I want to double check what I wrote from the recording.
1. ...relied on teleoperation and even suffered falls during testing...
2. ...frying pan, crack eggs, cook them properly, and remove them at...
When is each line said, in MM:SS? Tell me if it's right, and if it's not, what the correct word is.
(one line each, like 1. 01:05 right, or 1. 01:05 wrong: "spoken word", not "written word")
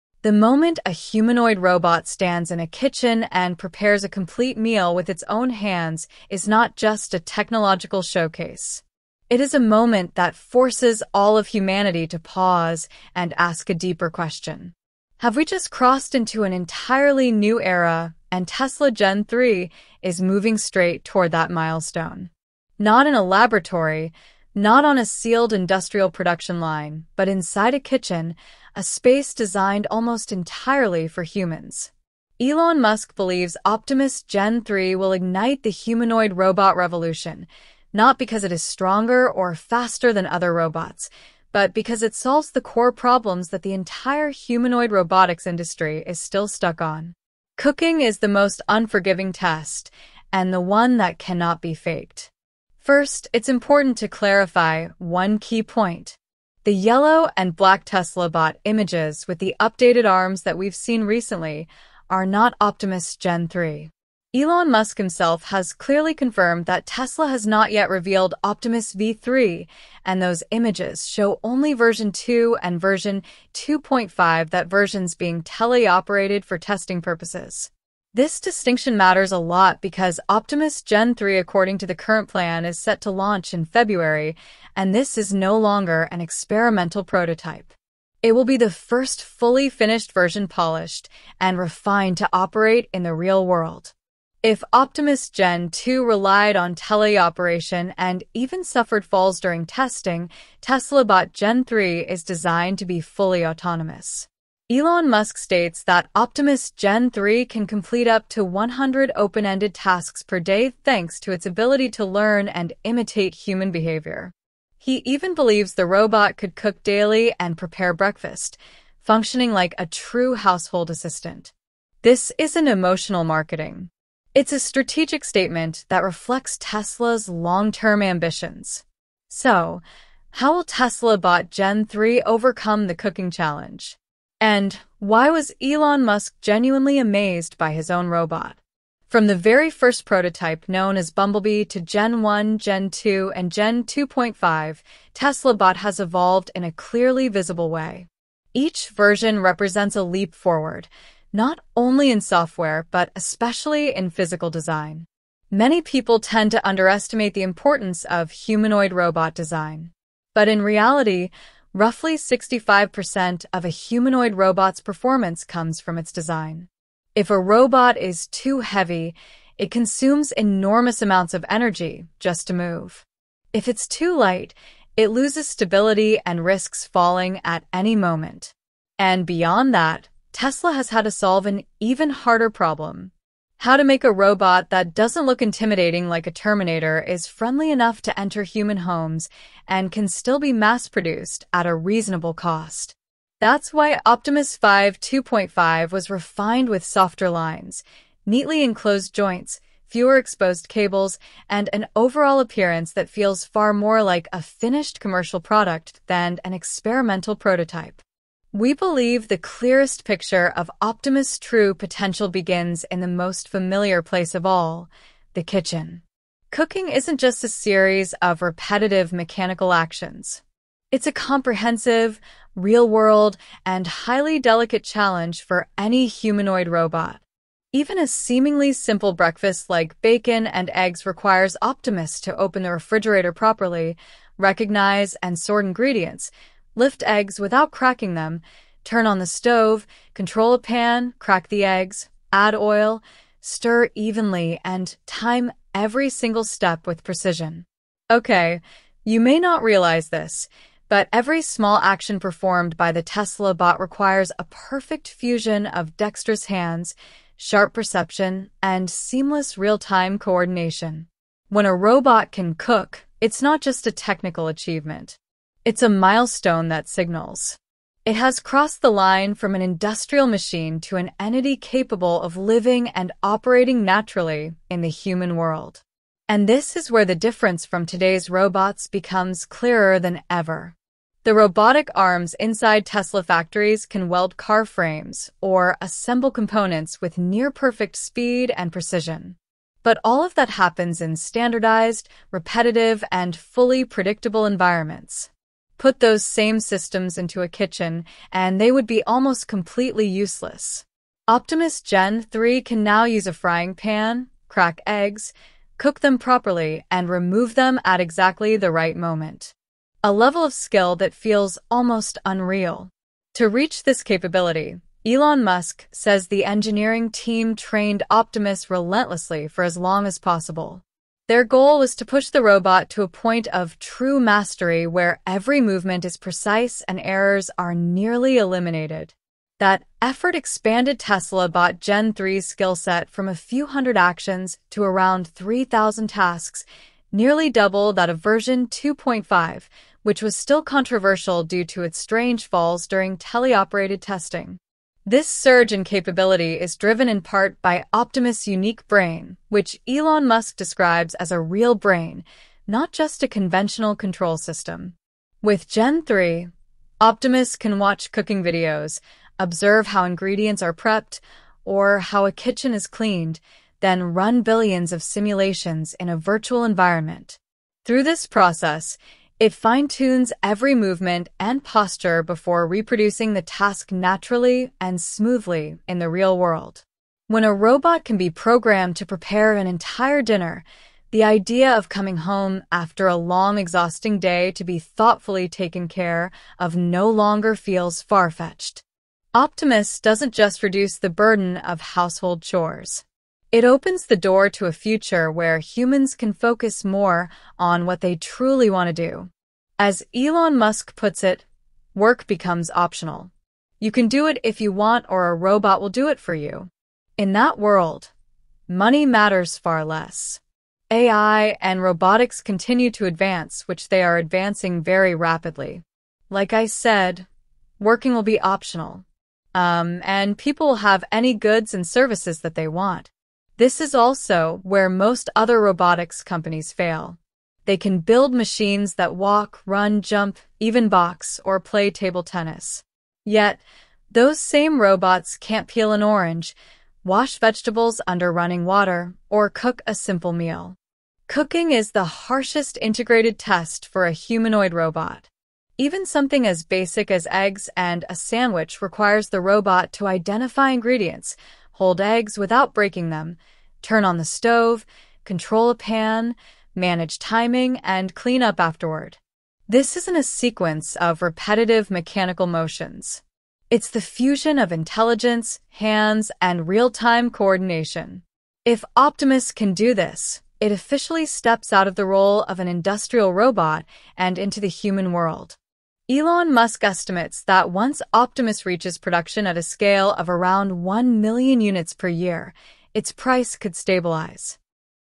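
1. 01:36 right
2. 05:03 right.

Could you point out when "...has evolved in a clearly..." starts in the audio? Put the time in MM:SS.
02:25.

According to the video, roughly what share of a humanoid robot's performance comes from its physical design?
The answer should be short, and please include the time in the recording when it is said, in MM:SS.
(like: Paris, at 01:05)
65%, at 02:42.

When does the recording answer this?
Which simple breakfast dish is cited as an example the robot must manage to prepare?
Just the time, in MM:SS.
03:50.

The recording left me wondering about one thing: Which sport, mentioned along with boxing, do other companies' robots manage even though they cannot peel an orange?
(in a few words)
table tennis.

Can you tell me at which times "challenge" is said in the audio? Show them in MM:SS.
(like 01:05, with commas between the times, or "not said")
02:13, 03:44.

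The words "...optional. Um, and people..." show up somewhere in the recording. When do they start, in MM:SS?
06:58.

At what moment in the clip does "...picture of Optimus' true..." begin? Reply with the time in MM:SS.
03:30.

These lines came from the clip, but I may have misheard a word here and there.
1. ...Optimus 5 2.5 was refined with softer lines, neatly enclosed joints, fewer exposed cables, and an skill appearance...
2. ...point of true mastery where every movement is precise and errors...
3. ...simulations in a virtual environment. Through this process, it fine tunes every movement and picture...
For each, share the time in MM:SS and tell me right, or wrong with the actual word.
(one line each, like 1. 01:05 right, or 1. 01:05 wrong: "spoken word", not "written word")
1. 03:14 wrong: "overall", not "skill"
2. 05:23 right
3. 06:05 wrong: "posture", not "picture".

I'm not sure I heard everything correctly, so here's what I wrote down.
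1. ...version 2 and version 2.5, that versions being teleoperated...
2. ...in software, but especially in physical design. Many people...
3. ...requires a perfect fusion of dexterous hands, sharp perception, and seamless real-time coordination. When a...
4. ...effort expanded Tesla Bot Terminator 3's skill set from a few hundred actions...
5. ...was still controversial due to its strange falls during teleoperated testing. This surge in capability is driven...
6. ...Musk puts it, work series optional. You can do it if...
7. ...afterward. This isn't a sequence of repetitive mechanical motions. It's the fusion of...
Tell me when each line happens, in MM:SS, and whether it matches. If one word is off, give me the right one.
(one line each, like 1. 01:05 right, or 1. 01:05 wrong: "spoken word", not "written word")
1. 01:11 right
2. 02:32 right
3. 04:13 right
4. 05:30 wrong: "Gen", not "Terminator"
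5. 05:40 right
6. 06:40 wrong: "becomes", not "series"
7. 07:38 right.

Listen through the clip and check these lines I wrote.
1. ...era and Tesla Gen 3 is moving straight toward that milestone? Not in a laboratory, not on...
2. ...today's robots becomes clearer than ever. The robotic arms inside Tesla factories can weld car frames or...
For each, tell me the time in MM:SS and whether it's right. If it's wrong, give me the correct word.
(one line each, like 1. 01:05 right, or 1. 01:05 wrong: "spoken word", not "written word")
1. 00:17 right
2. 04:37 right.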